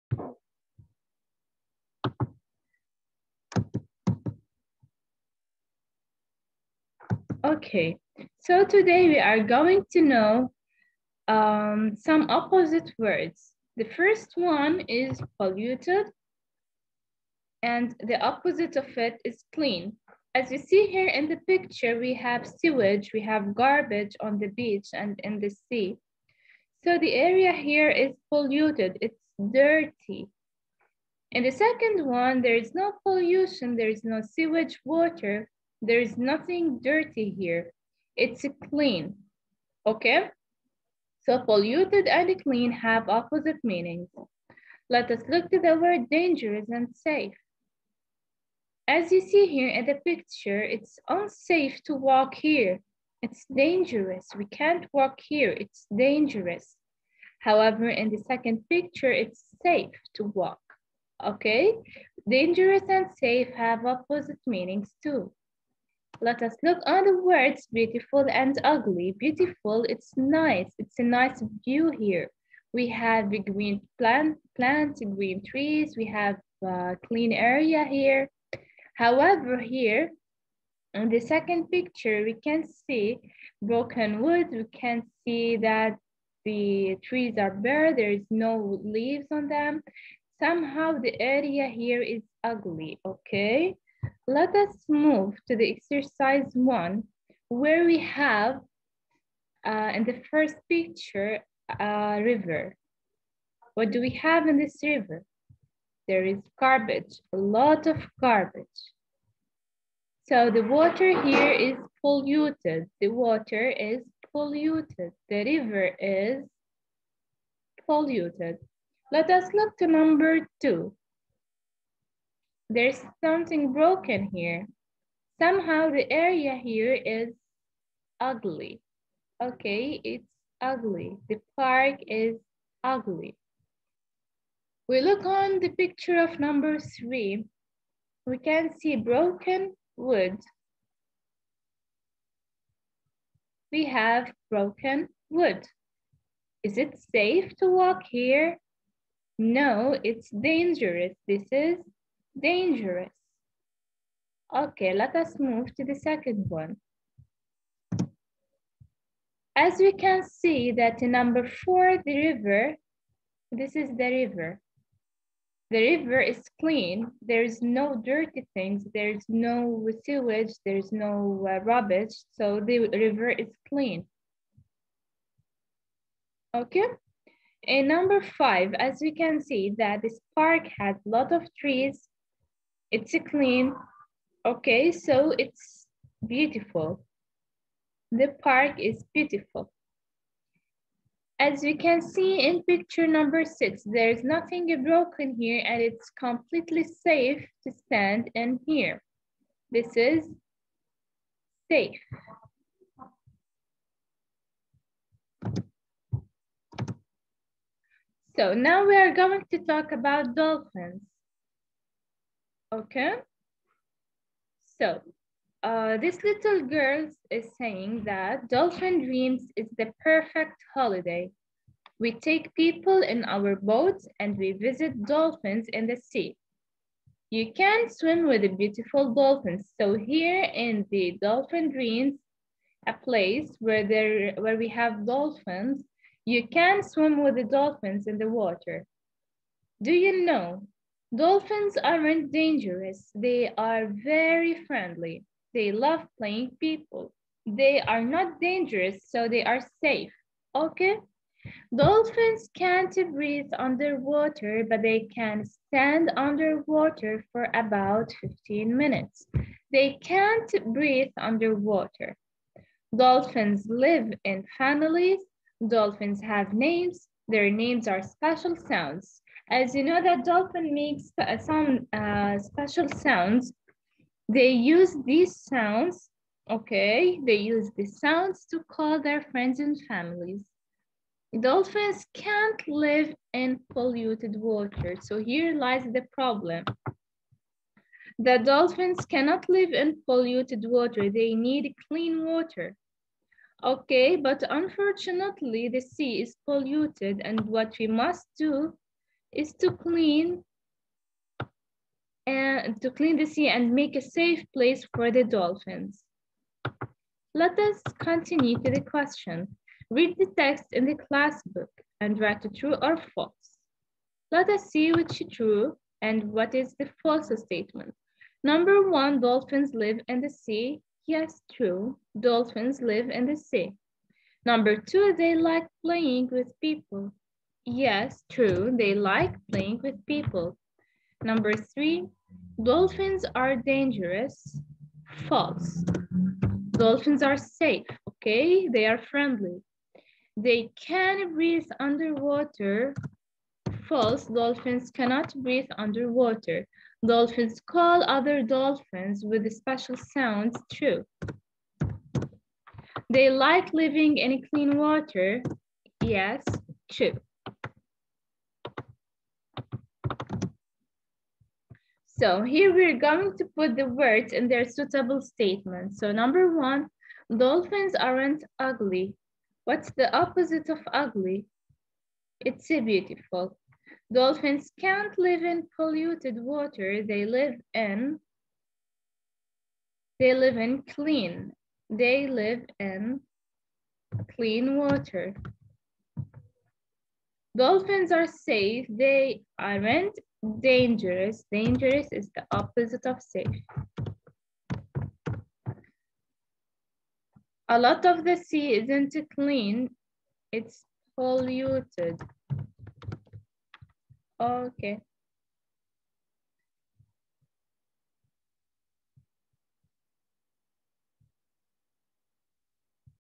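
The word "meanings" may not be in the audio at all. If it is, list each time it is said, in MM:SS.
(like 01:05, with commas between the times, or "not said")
00:43, 01:04.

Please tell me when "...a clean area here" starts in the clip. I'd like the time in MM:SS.
01:16.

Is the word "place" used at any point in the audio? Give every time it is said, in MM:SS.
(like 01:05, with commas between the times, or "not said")
03:52, 05:04.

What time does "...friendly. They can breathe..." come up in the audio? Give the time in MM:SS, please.
05:38.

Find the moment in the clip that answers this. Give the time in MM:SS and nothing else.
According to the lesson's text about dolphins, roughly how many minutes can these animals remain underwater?
04:18.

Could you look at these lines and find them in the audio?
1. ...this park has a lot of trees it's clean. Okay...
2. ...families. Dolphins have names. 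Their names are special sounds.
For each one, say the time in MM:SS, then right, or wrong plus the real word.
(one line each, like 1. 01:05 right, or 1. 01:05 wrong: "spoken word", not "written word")
1. 03:00 right
2. 04:24 right.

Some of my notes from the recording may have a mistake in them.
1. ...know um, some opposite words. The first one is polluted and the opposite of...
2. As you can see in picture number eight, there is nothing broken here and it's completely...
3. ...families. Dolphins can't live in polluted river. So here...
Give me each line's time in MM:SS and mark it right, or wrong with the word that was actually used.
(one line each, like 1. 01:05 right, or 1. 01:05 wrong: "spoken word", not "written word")
1. 00:10 right
2. 03:11 wrong: "six", not "eight"
3. 04:39 wrong: "water", not "river".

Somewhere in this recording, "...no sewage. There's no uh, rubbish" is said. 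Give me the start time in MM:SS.
02:49.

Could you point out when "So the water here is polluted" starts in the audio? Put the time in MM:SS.
01:50.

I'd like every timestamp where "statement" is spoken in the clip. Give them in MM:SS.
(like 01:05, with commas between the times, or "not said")
05:17, 06:05.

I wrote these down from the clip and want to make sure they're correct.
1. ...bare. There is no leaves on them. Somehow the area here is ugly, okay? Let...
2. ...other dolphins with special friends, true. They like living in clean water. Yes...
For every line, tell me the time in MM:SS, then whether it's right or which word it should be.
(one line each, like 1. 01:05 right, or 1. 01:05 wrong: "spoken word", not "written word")
1. 01:27 right
2. 05:48 wrong: "sounds", not "friends".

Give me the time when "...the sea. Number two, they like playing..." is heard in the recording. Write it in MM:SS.
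05:23.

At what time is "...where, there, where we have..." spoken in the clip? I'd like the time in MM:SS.
03:53.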